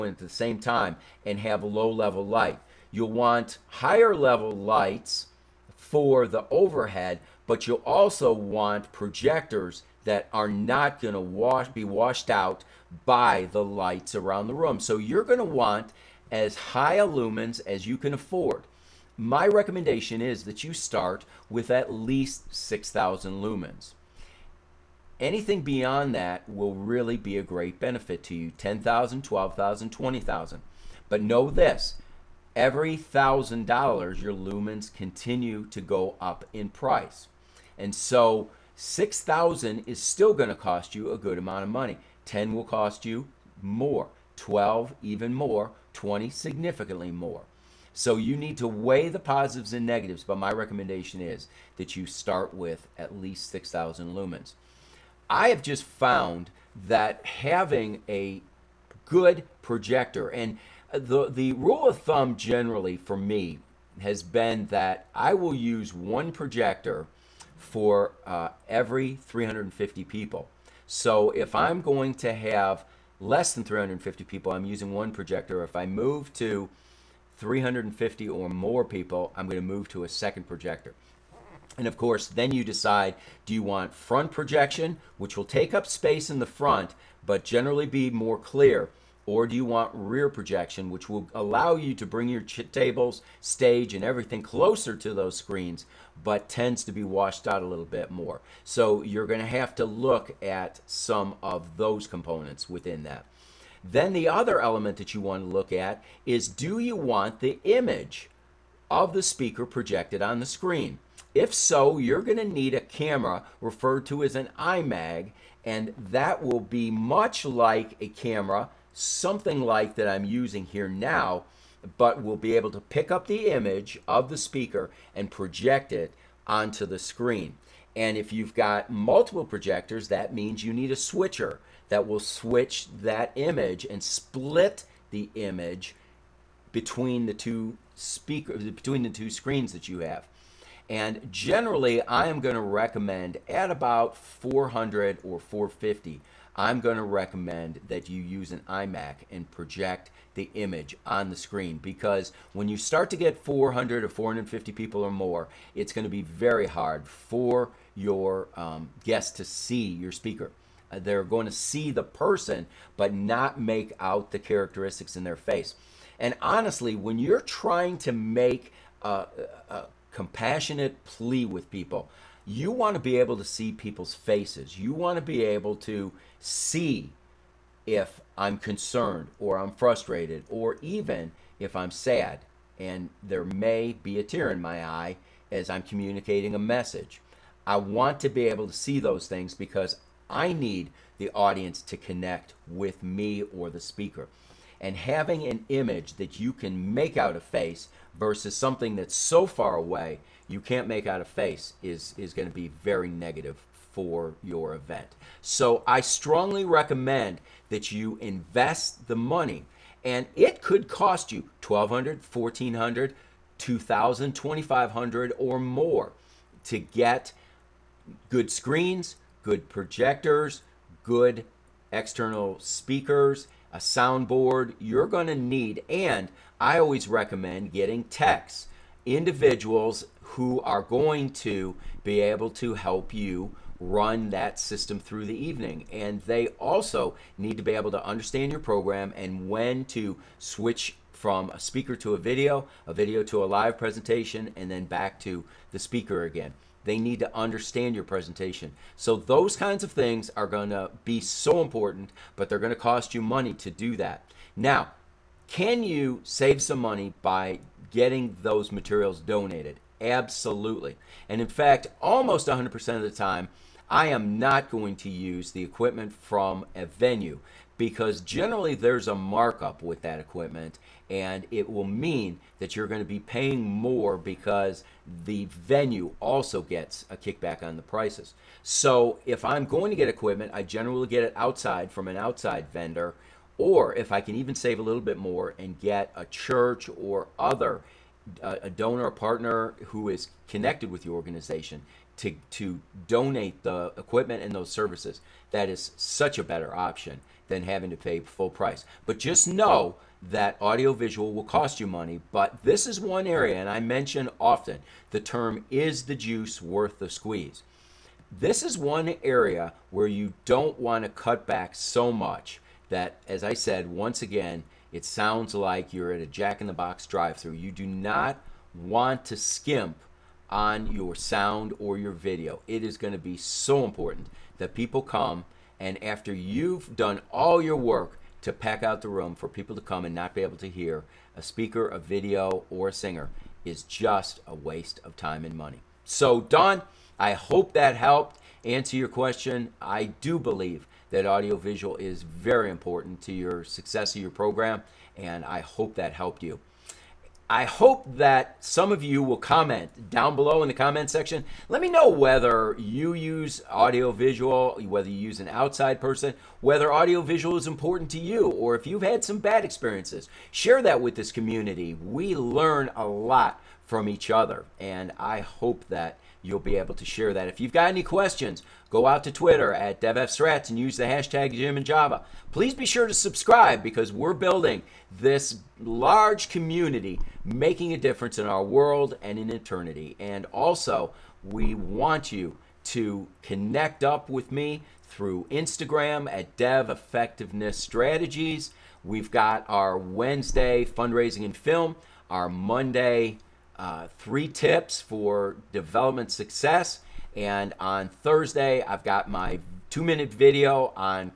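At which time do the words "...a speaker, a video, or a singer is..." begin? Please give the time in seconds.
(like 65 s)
331 s.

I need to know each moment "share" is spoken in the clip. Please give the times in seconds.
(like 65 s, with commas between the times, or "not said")
360 s, 367 s.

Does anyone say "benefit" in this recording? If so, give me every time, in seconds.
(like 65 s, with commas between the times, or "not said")
27 s.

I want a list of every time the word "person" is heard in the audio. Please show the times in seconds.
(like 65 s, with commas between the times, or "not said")
162 s, 356 s.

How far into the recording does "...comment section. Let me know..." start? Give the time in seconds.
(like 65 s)
350 s.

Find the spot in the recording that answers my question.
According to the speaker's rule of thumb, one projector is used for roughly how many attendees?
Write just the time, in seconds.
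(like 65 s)
68 s.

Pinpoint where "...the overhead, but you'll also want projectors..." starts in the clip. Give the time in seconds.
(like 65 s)
6 s.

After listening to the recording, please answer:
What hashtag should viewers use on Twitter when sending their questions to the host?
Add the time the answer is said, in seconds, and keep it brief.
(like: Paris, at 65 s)
Jim and Java, at 371 s.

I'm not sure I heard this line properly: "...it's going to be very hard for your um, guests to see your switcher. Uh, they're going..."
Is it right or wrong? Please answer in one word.
wrong.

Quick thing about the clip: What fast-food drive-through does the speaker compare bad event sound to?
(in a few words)
Jack in the Box.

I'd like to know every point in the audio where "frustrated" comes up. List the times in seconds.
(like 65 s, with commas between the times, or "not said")
179 s.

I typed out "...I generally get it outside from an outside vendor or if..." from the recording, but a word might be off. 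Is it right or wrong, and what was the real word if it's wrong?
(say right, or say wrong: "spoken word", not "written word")
right.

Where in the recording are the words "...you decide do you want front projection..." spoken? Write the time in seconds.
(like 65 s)
82 s.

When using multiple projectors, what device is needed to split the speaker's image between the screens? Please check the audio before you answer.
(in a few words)
a switcher.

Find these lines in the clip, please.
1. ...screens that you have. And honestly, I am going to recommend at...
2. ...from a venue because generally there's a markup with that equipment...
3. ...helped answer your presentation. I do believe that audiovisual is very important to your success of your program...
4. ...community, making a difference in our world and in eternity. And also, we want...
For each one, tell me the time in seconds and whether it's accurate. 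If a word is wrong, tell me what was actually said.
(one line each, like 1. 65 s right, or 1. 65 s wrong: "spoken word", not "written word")
1. 139 s wrong: "generally", not "honestly"
2. 266 s right
3. 337 s wrong: "question", not "presentation"
4. 376 s right.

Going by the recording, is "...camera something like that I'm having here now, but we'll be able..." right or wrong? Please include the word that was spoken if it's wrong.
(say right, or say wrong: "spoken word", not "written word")
wrong: "using", not "having".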